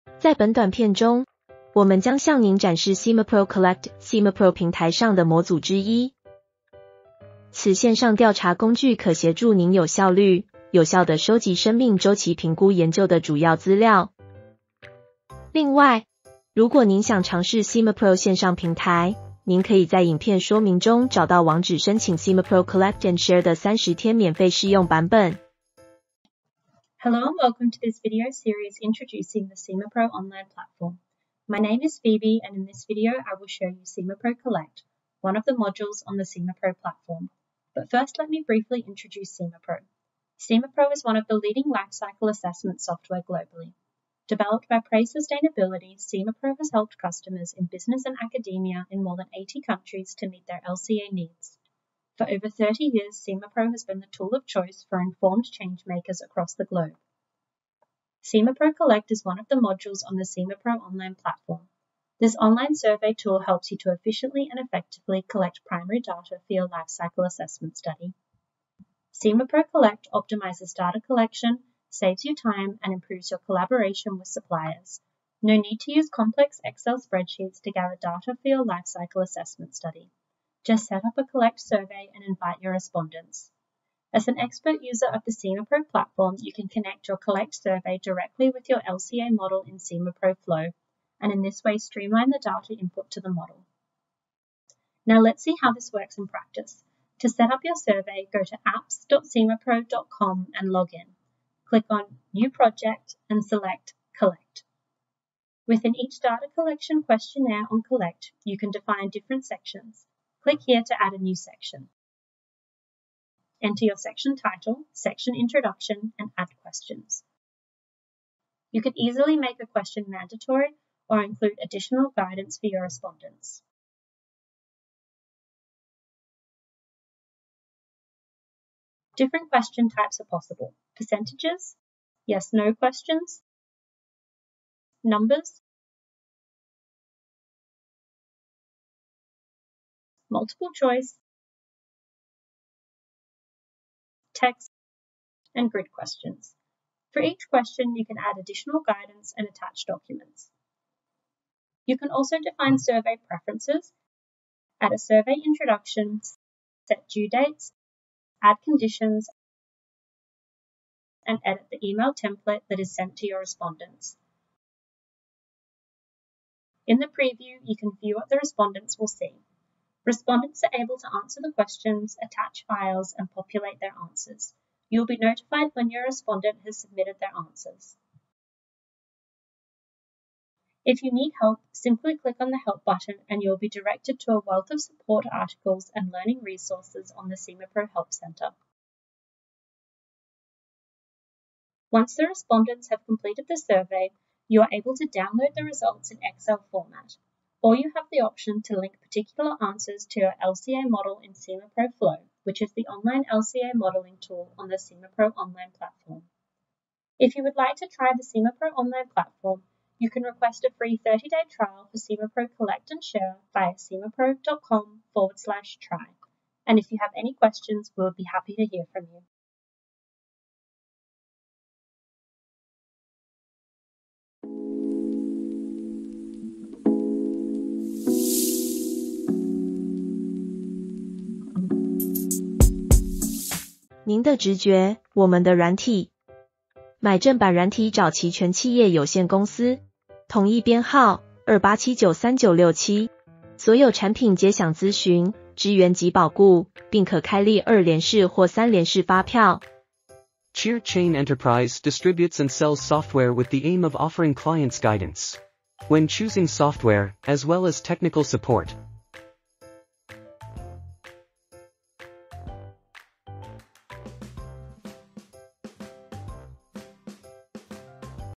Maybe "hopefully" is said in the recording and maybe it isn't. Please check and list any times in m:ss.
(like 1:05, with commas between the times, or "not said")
not said.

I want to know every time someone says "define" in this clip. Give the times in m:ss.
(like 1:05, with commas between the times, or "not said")
1:48, 2:32.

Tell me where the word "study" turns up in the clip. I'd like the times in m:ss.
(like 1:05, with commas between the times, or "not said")
1:07, 1:19.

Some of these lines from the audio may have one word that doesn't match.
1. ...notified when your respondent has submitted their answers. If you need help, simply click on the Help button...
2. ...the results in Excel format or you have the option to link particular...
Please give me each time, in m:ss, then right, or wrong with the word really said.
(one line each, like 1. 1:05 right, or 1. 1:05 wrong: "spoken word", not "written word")
1. 2:55 right
2. 3:15 right.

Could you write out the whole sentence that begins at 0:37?
But first let me briefly introduce SimaPro.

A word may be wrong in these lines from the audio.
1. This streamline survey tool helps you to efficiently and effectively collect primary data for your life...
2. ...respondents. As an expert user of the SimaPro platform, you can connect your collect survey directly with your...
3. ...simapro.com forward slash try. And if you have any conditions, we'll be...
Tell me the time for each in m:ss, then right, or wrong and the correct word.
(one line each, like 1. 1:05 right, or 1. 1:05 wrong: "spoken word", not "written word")
1. 1:02 wrong: "online", not "streamline"
2. 1:22 right
3. 3:33 wrong: "questions", not "conditions".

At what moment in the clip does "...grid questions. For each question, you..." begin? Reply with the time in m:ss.
2:25.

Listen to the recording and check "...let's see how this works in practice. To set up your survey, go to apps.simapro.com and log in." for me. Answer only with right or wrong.
right.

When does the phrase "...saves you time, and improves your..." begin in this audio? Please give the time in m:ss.
1:11.